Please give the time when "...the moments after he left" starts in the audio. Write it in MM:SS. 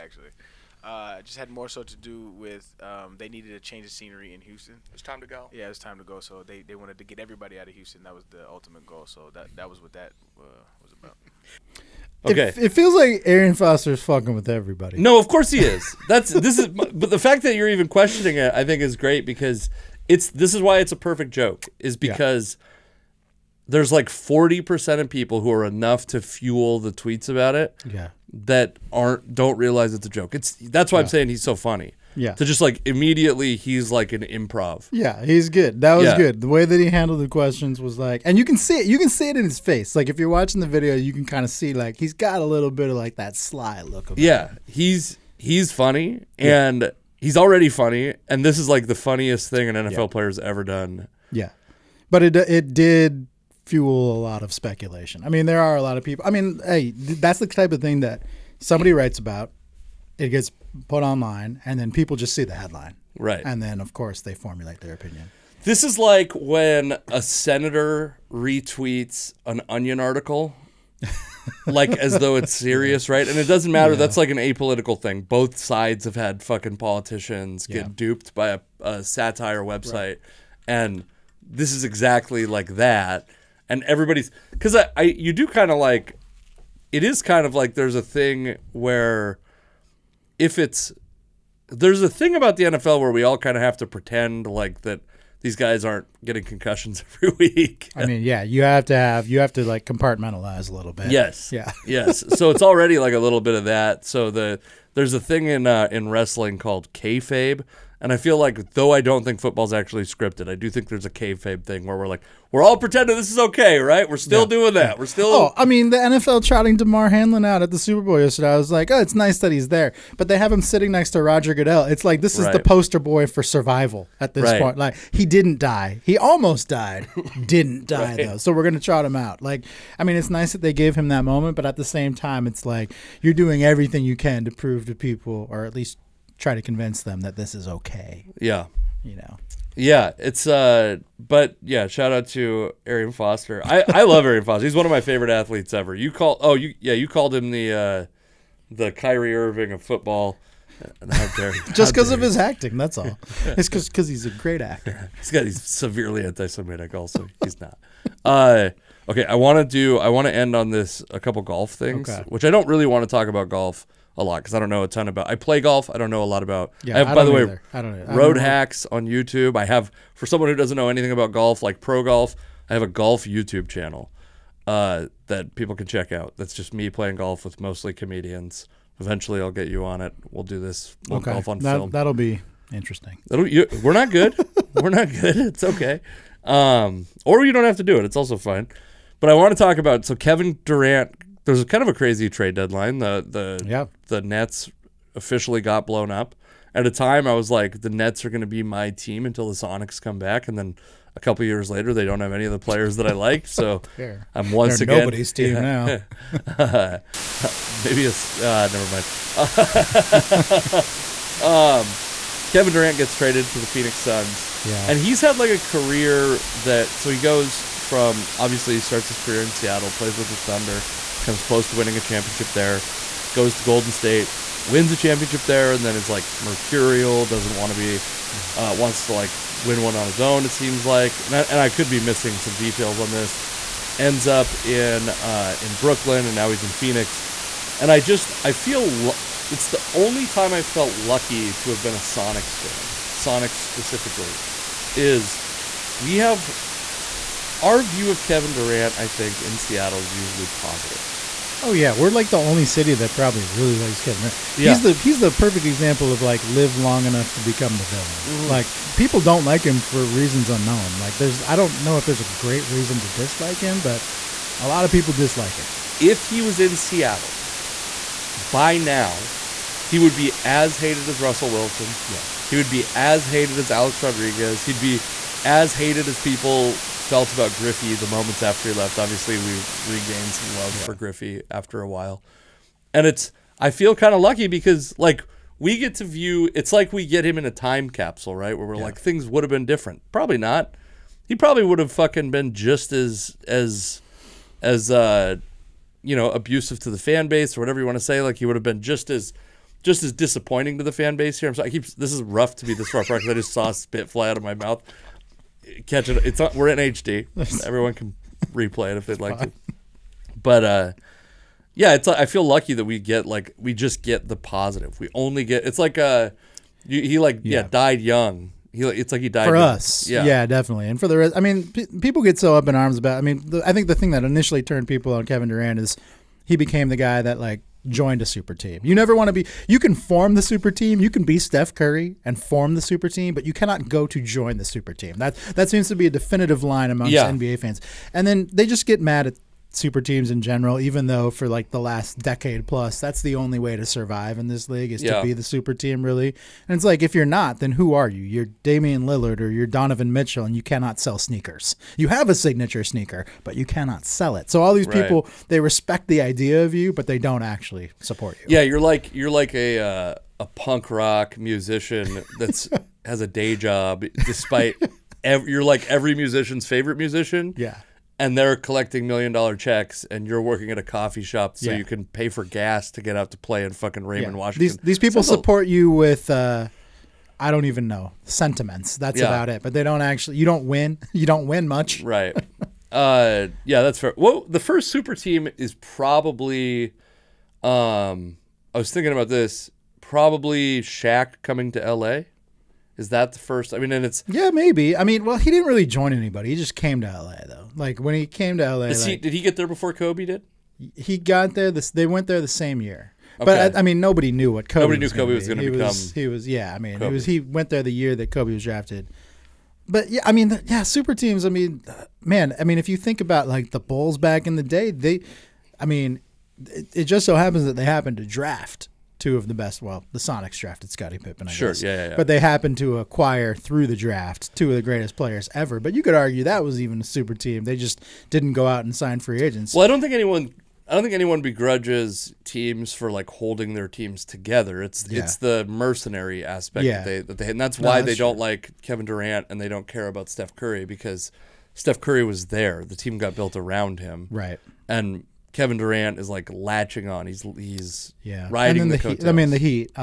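04:37.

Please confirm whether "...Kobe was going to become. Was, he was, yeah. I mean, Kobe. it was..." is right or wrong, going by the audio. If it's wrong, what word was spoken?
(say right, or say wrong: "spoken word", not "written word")
right.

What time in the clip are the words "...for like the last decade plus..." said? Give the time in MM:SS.
05:41.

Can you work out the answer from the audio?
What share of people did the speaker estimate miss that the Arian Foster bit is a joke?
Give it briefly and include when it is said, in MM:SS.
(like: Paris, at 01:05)
40%, at 00:24.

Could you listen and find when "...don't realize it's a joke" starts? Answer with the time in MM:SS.
00:29.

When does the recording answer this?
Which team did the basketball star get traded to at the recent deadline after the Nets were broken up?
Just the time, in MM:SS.
03:33.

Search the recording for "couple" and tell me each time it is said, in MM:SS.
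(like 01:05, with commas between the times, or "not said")
02:41, 03:21.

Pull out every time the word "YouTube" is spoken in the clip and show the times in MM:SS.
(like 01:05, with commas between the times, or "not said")
02:49, 02:53.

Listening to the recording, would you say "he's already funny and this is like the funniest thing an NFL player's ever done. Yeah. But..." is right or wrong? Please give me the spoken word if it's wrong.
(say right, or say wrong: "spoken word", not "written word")
right.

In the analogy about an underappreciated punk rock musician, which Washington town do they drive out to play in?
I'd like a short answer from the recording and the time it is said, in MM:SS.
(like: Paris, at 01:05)
Raymond, at 06:14.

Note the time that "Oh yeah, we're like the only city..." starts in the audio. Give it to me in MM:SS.
04:11.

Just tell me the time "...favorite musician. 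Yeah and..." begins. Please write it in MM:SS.
06:06.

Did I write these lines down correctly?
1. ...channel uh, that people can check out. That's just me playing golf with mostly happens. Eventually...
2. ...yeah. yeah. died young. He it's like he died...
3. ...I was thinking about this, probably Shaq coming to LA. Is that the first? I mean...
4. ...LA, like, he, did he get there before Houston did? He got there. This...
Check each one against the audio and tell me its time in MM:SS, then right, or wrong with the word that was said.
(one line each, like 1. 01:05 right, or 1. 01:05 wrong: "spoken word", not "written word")
1. 02:53 wrong: "comedians", not "happens"
2. 05:17 right
3. 06:28 right
4. 06:38 wrong: "Kobe", not "Houston".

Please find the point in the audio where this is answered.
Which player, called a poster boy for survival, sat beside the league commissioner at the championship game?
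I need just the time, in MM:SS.
01:56.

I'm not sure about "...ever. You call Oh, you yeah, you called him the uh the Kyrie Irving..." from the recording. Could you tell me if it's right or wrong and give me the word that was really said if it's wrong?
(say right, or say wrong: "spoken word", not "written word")
right.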